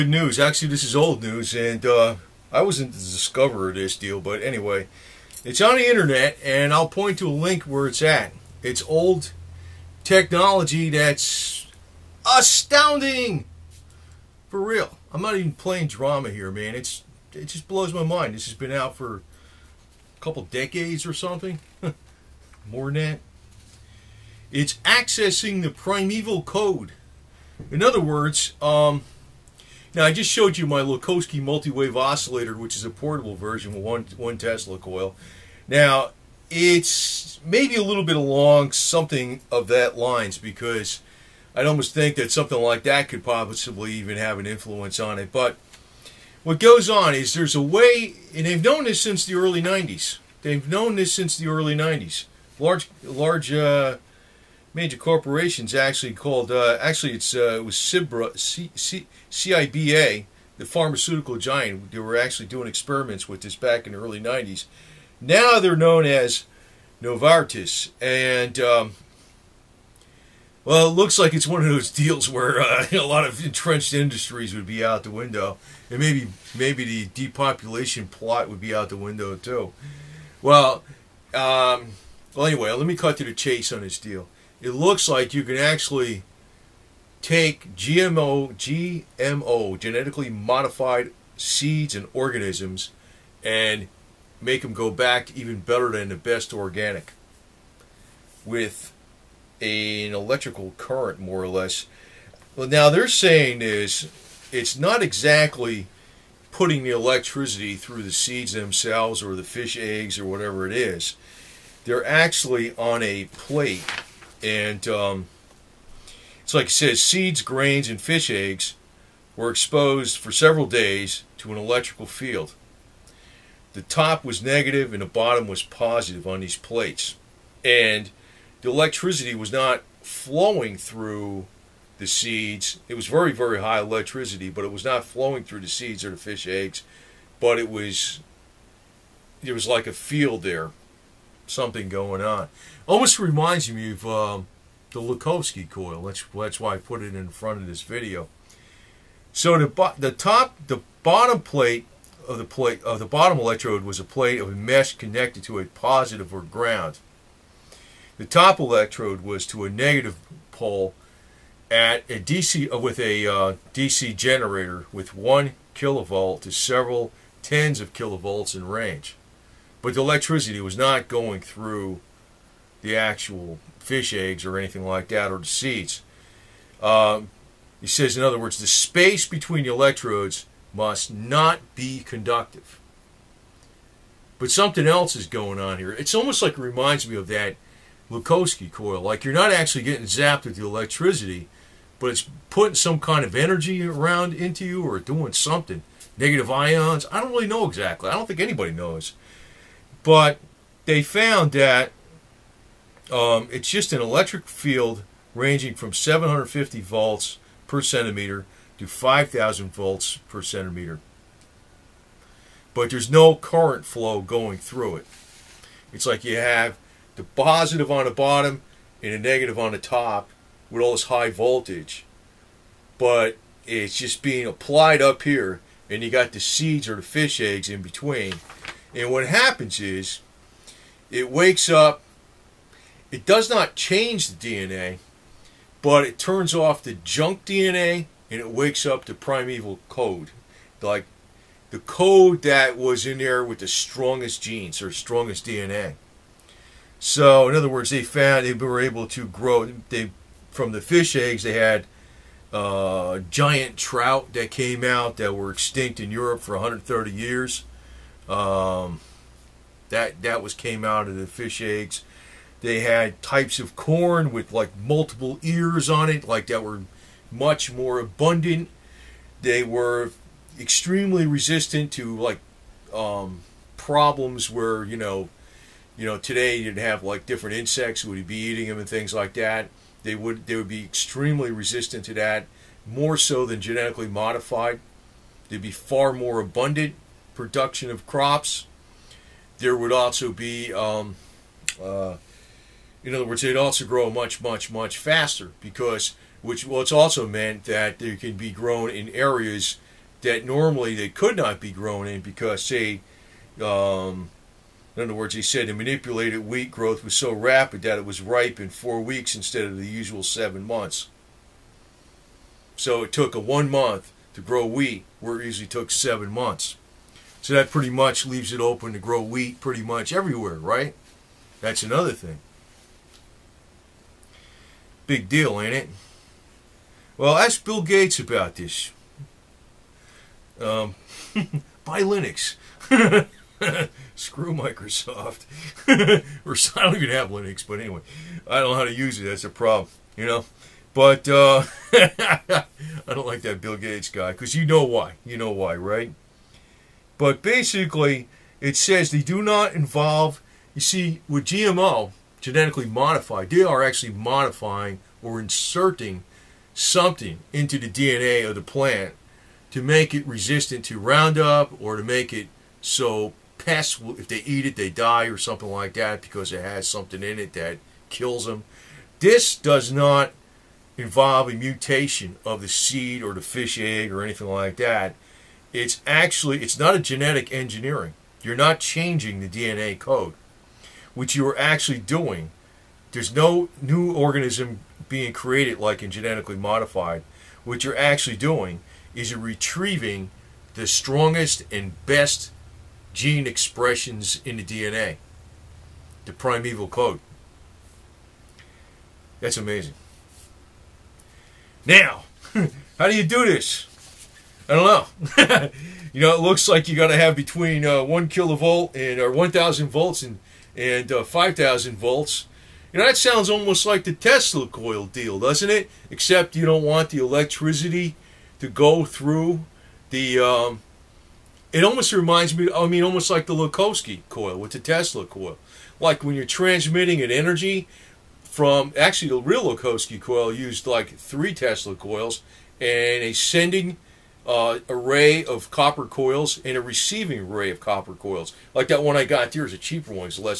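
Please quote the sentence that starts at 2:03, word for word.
The top was negative and the bottom was positive on these plates.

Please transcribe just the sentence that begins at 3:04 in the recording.
But something else is going on here.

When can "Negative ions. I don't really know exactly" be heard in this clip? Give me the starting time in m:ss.
3:16.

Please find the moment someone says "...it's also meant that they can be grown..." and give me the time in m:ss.
4:56.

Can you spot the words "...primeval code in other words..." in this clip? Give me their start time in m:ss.
0:25.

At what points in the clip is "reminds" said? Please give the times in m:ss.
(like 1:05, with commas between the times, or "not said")
2:23, 3:06, 7:02.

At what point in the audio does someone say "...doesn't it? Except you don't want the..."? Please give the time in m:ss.
6:55.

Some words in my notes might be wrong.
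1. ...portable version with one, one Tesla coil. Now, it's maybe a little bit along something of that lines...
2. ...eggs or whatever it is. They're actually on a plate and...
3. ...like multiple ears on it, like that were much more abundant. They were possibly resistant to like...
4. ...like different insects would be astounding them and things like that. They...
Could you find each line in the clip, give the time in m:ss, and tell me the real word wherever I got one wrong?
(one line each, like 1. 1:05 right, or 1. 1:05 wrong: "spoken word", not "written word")
1. 0:32 right
2. 1:49 right
3. 4:24 wrong: "extremely", not "possibly"
4. 4:37 wrong: "eating", not "astounding".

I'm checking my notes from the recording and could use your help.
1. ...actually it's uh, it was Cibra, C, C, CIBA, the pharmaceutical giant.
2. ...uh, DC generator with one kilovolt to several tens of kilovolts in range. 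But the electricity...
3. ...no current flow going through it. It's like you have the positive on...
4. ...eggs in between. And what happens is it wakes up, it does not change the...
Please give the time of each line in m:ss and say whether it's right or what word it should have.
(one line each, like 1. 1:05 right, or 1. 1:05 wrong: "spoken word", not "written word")
1. 0:56 right
2. 2:43 right
3. 3:33 right
4. 3:47 right.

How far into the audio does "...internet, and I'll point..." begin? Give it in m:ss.
0:05.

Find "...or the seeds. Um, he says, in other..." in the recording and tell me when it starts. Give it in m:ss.
2:55.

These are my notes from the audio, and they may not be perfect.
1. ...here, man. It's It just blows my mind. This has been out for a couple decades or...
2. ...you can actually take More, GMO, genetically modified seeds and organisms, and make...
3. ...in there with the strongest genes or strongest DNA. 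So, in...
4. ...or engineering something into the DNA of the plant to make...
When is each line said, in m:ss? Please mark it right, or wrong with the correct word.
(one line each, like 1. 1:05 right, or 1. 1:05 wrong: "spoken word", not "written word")
1. 0:16 right
2. 1:25 wrong: "GMO", not "More"
3. 4:03 right
4. 5:55 wrong: "inserting", not "engineering".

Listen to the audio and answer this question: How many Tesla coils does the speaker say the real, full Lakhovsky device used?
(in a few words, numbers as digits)
3.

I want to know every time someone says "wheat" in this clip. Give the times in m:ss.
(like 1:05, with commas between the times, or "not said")
5:06, 5:14, 5:19.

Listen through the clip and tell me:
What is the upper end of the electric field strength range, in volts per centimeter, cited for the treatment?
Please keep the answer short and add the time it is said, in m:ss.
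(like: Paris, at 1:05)
5,000 volts per centimeter, at 3:28.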